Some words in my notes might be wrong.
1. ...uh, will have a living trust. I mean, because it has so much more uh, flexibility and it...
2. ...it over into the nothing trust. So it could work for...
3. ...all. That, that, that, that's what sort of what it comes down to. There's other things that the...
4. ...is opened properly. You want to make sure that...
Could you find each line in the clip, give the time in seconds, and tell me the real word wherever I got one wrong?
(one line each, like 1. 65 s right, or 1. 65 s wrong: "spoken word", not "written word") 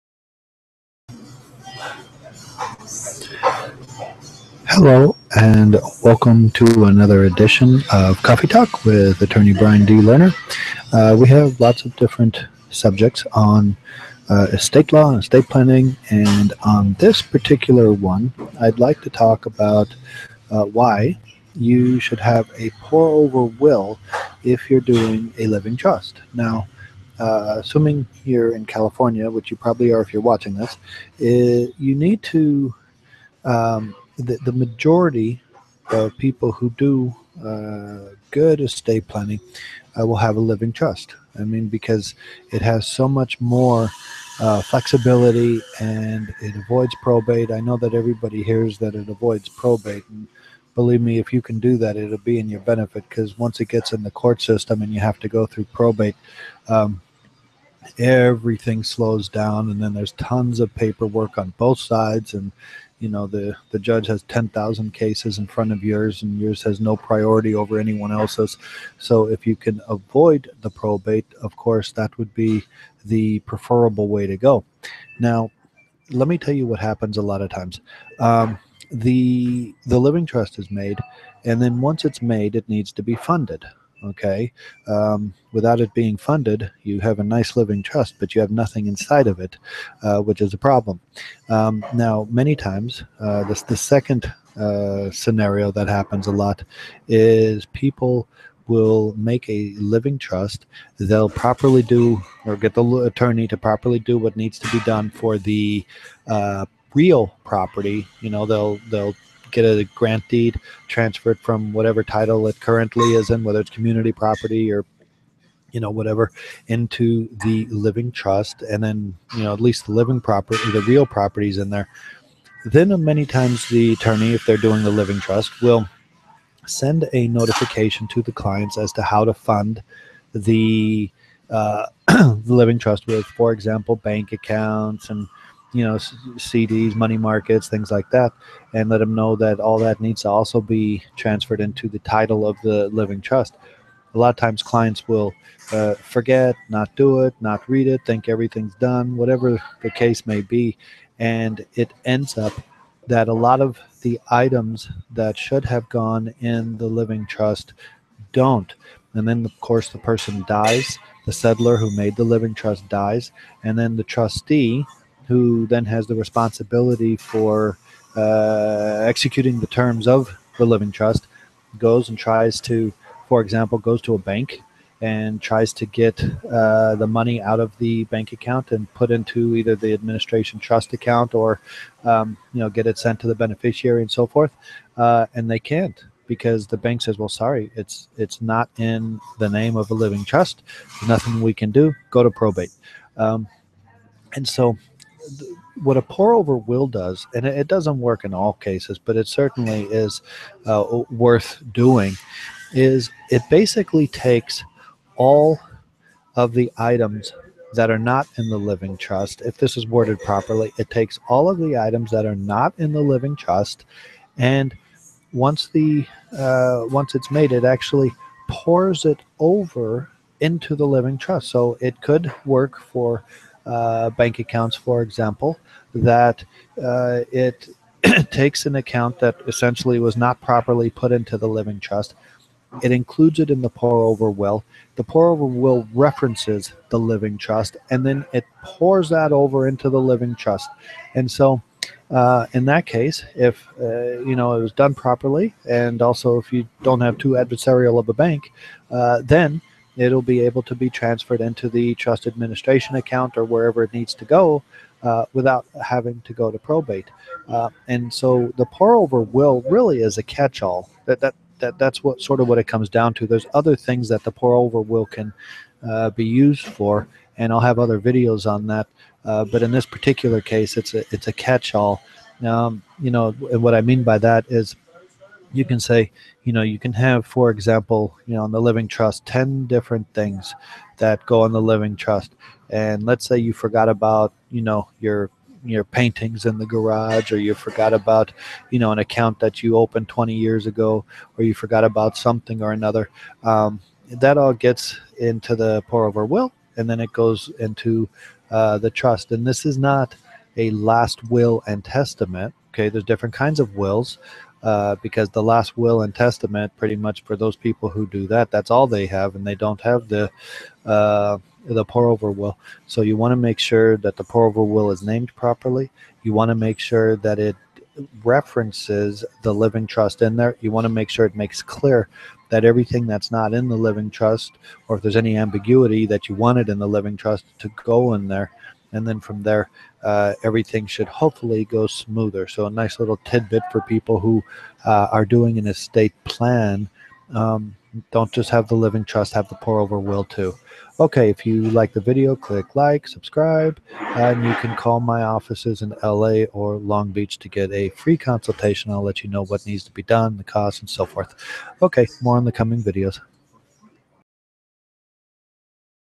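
1. 39 s right
2. 219 s wrong: "living", not "nothing"
3. 260 s right
4. 314 s wrong: "named", not "opened".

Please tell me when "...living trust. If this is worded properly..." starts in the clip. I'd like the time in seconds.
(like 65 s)
208 s.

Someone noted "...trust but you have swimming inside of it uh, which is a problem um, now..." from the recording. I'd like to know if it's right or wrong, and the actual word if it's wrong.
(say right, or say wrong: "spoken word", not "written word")
wrong: "nothing", not "swimming".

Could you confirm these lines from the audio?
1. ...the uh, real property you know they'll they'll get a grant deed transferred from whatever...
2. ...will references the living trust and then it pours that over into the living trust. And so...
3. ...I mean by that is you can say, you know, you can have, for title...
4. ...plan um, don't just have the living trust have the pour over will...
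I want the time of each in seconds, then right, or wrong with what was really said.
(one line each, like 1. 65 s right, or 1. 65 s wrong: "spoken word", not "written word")
1. 105 s right
2. 235 s right
3. 273 s wrong: "example", not "title"
4. 336 s right.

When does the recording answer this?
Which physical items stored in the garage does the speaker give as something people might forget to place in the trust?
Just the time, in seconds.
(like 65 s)
285 s.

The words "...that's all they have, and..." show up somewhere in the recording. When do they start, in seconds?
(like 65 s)
308 s.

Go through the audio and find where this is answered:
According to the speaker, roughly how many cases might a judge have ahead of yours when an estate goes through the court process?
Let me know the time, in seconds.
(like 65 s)
64 s.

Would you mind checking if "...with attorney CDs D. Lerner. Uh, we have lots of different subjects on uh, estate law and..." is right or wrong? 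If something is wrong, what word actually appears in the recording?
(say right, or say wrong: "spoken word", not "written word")
wrong: "Brian", not "CDs".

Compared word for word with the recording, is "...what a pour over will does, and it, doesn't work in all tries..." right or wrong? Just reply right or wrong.
wrong.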